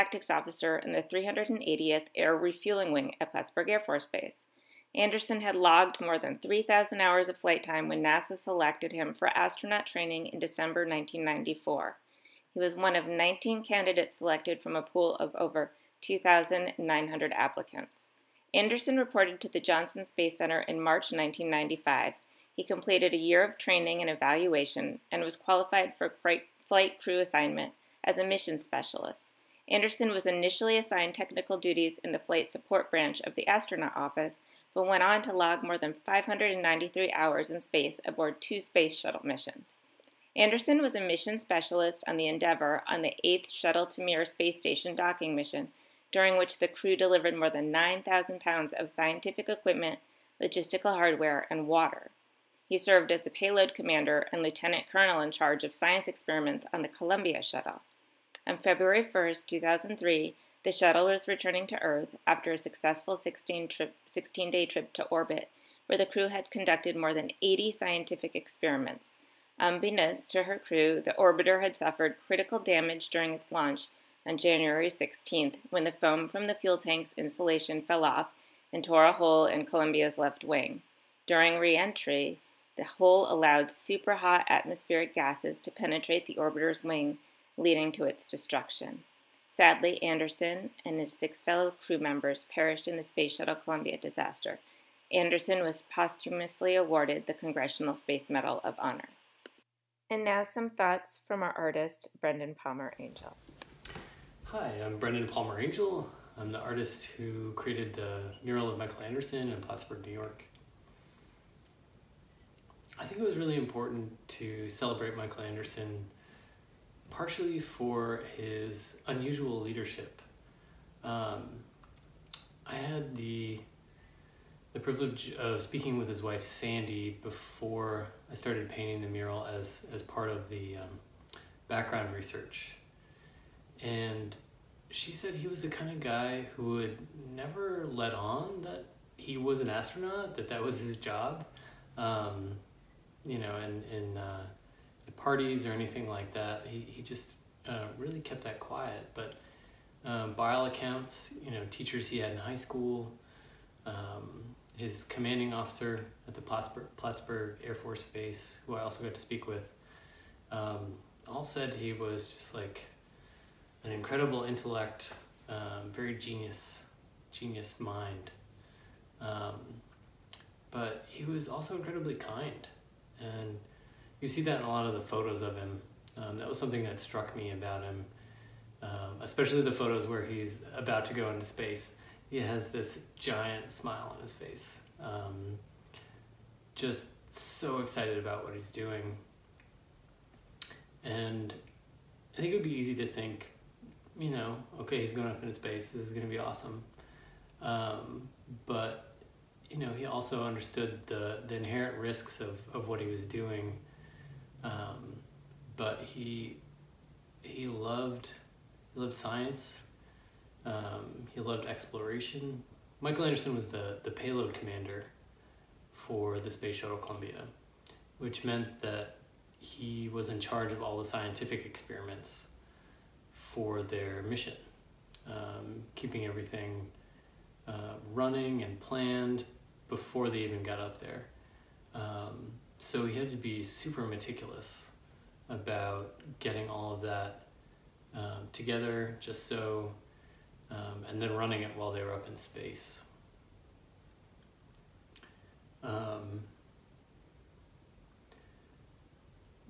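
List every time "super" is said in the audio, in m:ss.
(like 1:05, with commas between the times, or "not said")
1:23, 3:53.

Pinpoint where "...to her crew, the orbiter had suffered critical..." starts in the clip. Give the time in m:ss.
1:10.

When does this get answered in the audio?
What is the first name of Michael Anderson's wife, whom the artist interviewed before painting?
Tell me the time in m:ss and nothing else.
2:06.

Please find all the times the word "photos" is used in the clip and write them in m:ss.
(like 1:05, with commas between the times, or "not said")
2:55, 2:59.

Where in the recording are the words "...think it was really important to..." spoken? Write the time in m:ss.
1:53.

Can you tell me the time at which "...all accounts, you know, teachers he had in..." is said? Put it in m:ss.
2:30.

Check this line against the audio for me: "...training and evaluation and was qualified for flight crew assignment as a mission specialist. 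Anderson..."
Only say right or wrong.
right.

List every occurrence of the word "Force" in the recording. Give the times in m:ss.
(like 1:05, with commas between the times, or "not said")
0:03, 2:37.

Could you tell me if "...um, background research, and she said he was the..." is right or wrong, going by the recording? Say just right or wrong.
right.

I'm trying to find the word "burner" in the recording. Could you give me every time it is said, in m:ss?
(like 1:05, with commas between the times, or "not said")
not said.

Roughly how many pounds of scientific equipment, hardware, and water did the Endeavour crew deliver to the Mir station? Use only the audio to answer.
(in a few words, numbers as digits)
9,000.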